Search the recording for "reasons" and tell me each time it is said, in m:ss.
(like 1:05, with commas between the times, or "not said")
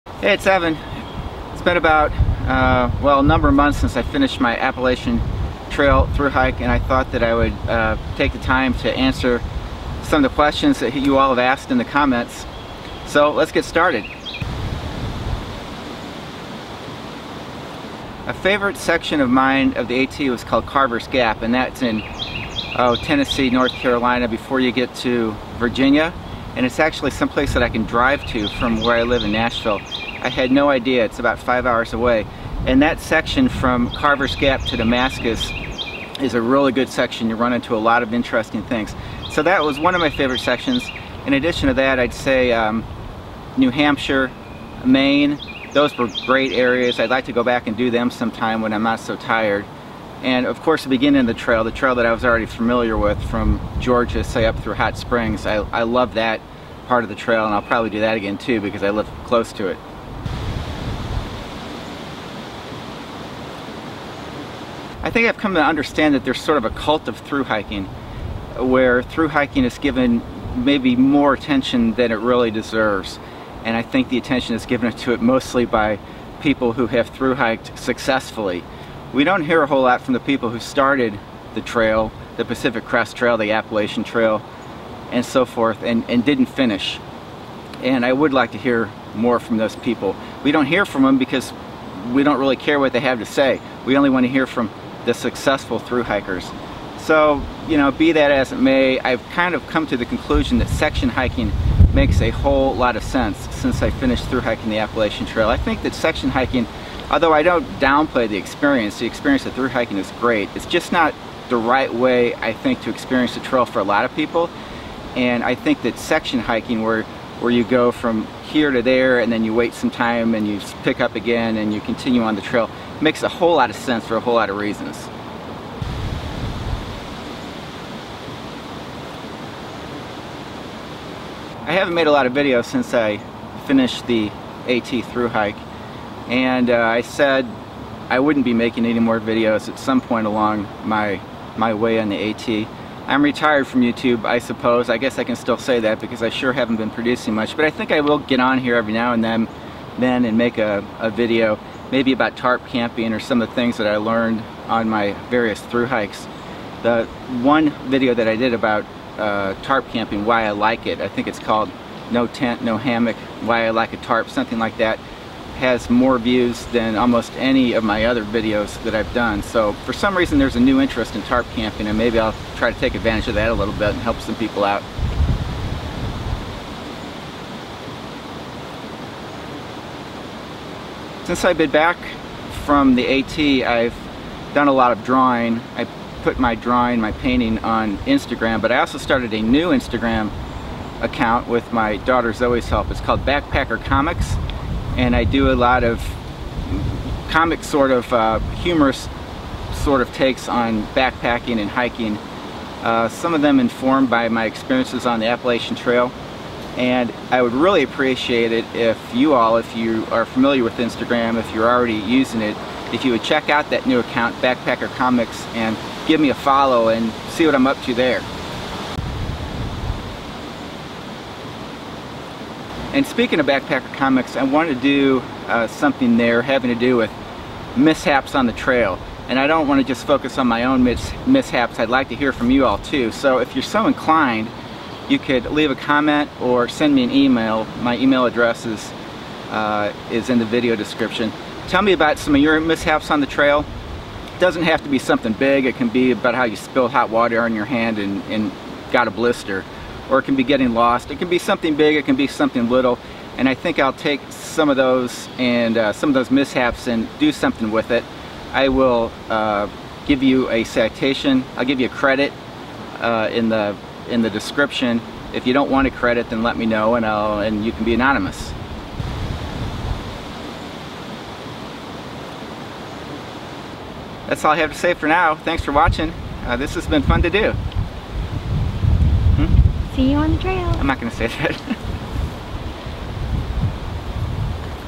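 2:04, 2:50.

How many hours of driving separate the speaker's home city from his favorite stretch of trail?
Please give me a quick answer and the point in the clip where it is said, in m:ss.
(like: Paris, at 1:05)
5, at 0:31.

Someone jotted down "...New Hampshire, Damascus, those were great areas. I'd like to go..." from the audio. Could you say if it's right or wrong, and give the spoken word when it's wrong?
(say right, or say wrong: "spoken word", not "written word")
wrong: "Maine", not "Damascus".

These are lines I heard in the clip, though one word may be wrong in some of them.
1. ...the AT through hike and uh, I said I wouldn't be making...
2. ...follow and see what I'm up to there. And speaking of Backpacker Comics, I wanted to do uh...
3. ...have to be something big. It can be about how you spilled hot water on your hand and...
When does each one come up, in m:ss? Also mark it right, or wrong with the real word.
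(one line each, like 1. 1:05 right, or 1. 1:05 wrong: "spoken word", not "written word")
1. 2:14 right
2. 3:36 right
3. 4:04 right.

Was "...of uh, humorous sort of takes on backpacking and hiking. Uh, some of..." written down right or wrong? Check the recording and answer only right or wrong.
right.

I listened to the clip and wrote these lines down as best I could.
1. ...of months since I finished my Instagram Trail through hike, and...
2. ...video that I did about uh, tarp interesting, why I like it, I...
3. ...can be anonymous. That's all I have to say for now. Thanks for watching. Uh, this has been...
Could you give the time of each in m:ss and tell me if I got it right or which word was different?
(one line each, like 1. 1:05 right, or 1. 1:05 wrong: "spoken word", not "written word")
1. 0:03 wrong: "Appalachian", not "Instagram"
2. 2:37 wrong: "camping", not "interesting"
3. 4:27 right.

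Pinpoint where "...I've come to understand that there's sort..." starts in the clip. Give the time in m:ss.
1:05.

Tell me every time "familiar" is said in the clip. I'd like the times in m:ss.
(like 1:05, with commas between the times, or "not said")
0:52, 3:30.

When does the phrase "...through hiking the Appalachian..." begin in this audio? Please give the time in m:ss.
1:44.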